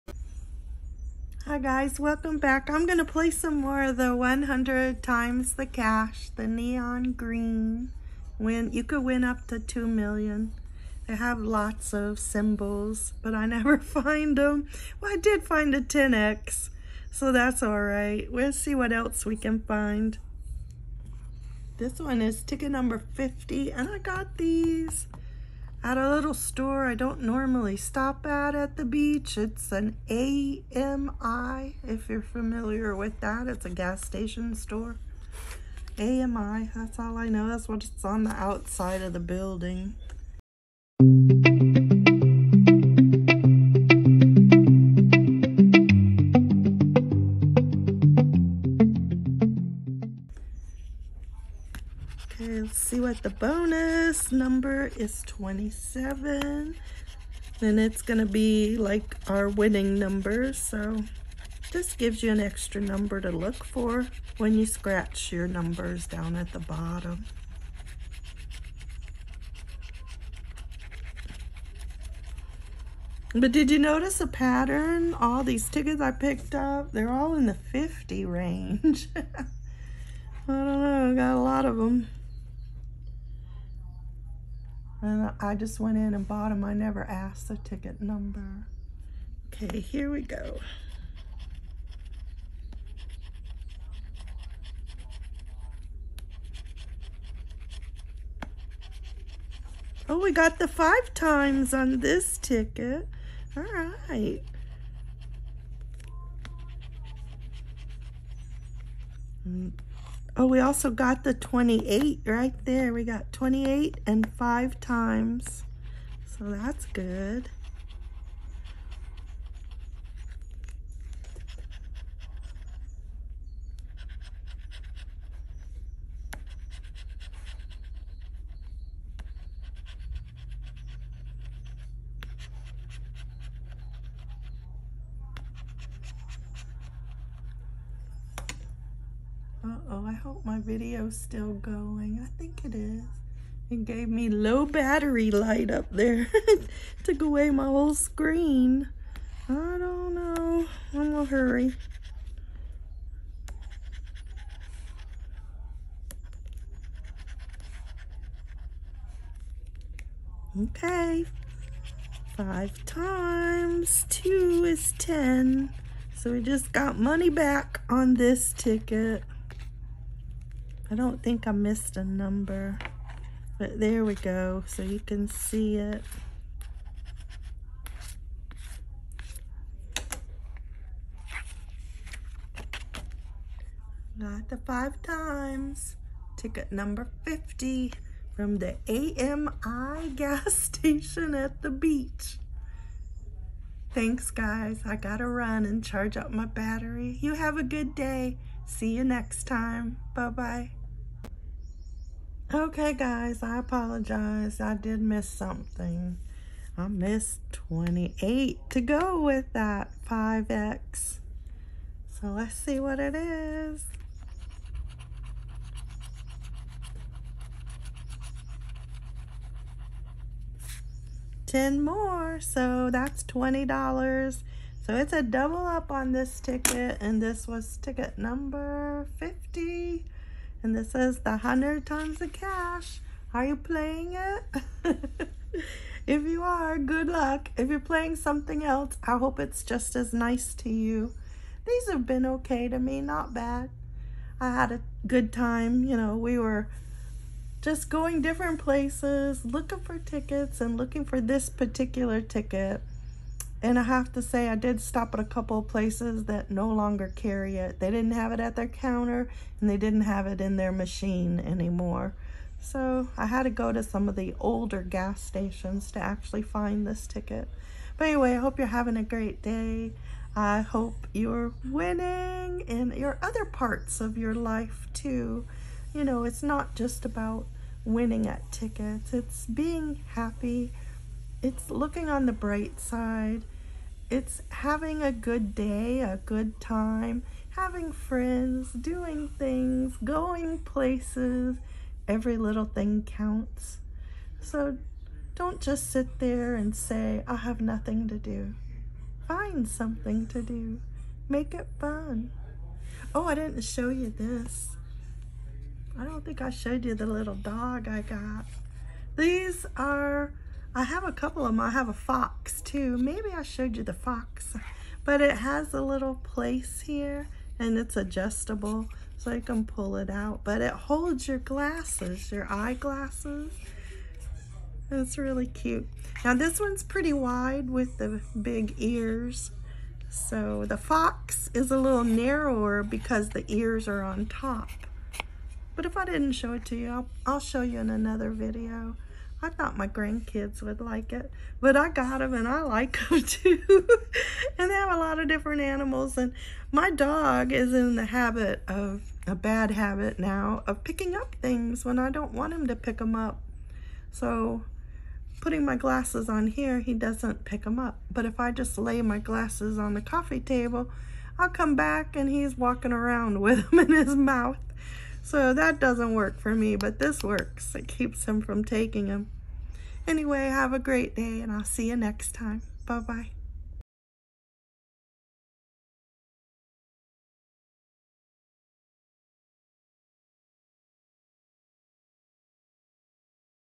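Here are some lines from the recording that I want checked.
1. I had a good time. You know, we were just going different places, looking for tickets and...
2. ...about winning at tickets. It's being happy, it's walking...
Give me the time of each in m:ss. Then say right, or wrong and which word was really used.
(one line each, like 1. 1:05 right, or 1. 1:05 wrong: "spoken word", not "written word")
1. 4:04 right
2. 4:37 wrong: "looking", not "walking".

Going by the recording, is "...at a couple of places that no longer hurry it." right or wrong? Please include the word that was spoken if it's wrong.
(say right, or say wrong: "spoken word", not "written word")
wrong: "carry", not "hurry".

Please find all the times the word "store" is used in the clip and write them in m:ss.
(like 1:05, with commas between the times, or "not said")
0:26, 0:34.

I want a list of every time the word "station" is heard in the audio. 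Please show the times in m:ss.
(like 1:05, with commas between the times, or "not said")
0:34, 3:10, 4:25.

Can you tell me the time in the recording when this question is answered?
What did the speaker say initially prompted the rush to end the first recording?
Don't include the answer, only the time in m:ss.
2:24.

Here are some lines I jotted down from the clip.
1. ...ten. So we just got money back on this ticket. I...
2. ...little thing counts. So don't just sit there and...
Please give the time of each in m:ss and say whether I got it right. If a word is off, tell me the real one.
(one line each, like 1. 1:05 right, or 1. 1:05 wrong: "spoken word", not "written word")
1. 2:44 right
2. 4:52 right.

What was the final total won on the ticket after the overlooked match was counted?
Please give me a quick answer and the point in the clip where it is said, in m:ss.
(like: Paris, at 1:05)
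$20, at 3:43.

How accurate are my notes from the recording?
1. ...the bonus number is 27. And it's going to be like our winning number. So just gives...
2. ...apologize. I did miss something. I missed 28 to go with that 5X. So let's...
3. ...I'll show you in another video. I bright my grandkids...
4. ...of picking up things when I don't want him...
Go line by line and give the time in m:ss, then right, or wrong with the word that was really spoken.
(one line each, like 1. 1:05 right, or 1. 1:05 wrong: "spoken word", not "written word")
1. 0:53 right
2. 3:23 right
3. 5:37 wrong: "thought", not "bright"
4. 5:50 right.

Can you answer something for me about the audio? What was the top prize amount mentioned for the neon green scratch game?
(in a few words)
2 million.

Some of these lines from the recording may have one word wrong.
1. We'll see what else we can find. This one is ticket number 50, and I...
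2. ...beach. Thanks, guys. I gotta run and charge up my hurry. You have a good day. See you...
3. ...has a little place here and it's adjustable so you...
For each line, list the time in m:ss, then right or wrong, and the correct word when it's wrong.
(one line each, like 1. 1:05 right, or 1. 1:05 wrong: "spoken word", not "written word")
1. 0:18 right
2. 3:11 wrong: "battery", not "hurry"
3. 5:15 right.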